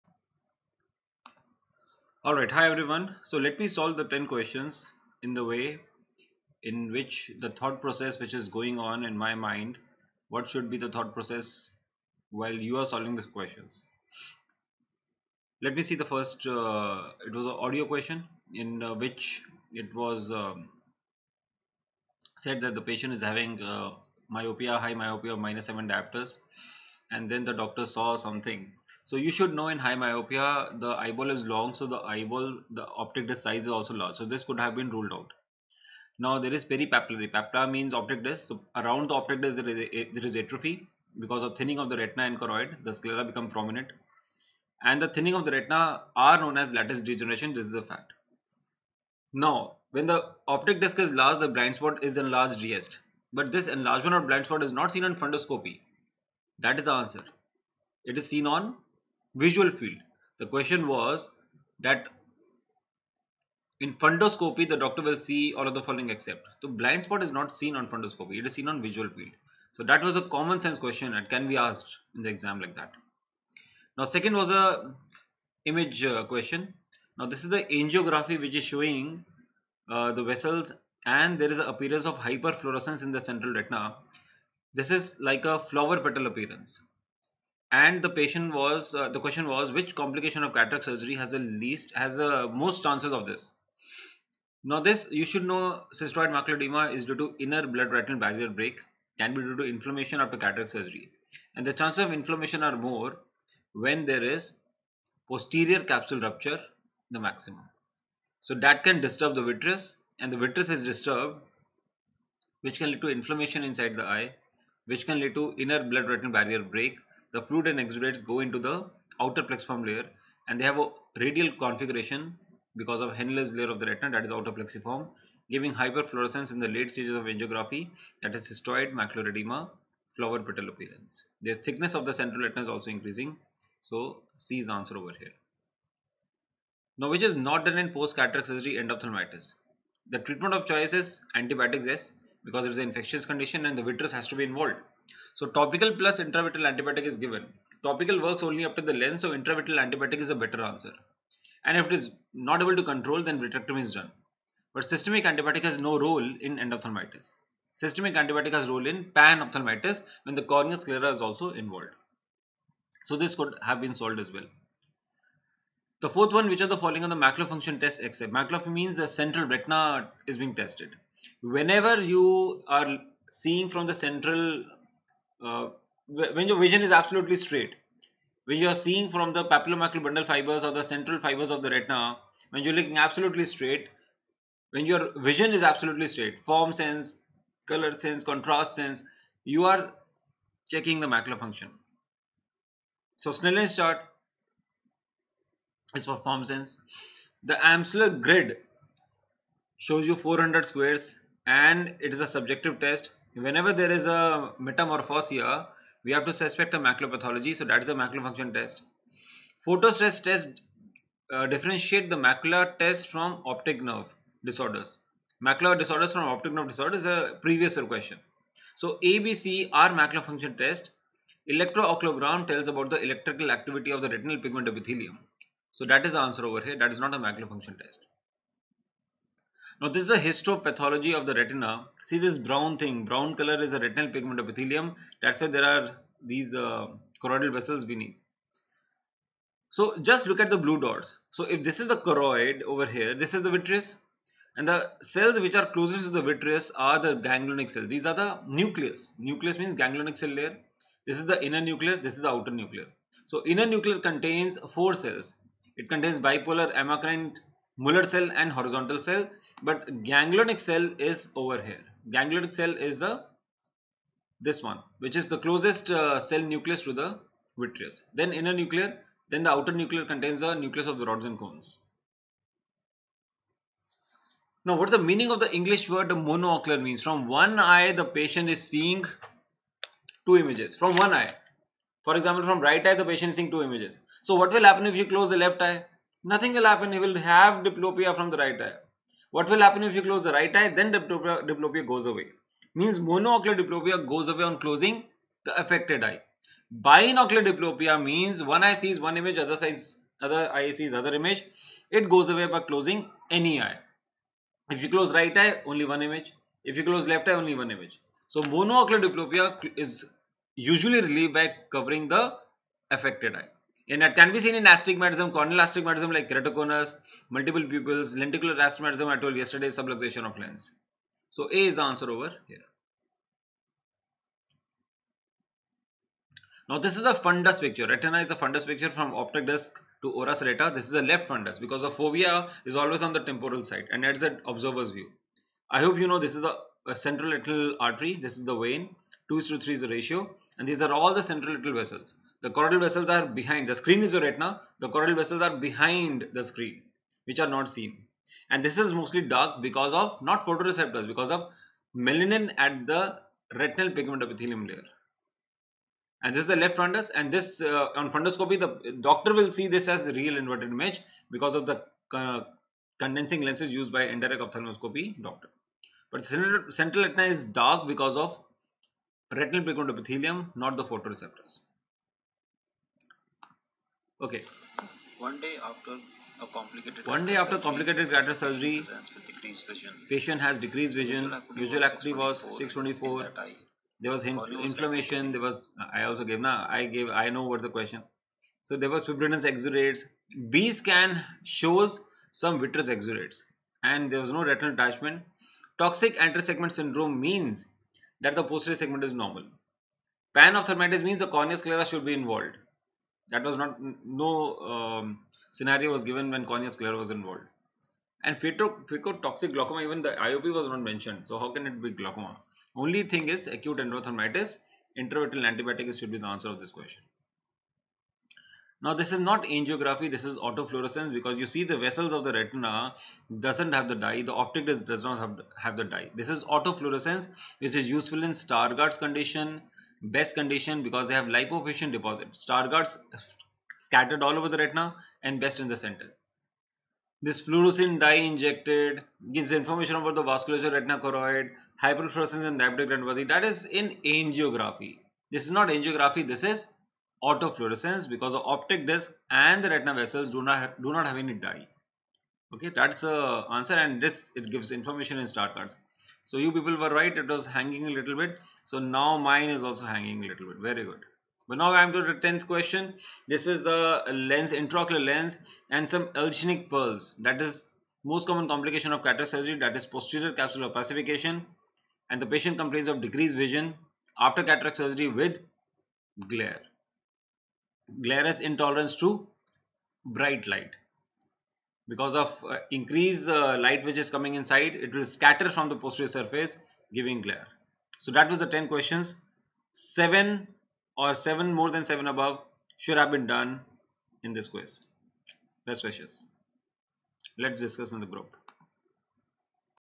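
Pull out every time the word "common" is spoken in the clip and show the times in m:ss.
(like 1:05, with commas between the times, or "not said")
1:10, 7:48.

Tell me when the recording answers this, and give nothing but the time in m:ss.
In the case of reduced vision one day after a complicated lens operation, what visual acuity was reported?
6:22.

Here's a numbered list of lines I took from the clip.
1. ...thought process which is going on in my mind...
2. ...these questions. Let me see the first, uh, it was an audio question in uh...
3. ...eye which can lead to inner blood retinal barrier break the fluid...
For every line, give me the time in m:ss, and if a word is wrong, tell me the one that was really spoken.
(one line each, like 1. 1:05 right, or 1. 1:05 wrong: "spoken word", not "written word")
1. 0:07 right
2. 0:13 right
3. 1:54 right.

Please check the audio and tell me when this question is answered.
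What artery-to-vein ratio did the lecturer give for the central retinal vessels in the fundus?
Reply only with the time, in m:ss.
5:39.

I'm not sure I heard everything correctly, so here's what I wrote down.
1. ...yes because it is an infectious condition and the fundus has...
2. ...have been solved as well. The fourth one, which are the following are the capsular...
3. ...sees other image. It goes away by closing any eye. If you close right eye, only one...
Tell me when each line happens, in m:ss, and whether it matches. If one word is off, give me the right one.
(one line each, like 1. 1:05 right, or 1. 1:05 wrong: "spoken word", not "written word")
1. 2:21 wrong: "vitreous", not "fundus"
2. 2:43 wrong: "macular", not "capsular"
3. 5:00 right.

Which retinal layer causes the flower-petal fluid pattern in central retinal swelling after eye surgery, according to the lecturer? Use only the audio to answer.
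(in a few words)
Henle's layer.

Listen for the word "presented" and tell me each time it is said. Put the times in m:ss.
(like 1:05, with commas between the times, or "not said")
not said.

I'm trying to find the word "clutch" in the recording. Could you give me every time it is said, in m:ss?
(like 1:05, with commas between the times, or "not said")
not said.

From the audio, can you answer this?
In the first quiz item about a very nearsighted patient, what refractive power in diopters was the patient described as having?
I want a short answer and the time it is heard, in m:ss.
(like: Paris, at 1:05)
-7 diopters, at 0:25.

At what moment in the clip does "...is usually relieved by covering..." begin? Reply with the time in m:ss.
5:09.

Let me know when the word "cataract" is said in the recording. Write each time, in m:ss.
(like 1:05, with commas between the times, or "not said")
1:30, 1:40, 2:18, 6:18, 7:49, 7:54.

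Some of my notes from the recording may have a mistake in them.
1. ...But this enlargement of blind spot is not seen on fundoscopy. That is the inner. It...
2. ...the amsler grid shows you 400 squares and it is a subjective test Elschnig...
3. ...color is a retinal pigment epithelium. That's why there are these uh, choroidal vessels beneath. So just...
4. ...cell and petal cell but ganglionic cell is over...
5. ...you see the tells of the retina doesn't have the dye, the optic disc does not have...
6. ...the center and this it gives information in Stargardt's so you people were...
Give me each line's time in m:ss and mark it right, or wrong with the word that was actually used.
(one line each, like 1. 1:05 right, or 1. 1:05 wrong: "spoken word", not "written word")
1. 0:53 wrong: "answer", not "inner"
2. 3:17 wrong: "Whenever", not "Elschnig"
3. 3:53 right
4. 4:18 wrong: "horizontal", not "petal"
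5. 7:01 wrong: "vessels", not "tells"
6. 7:33 wrong: "answer", not "center".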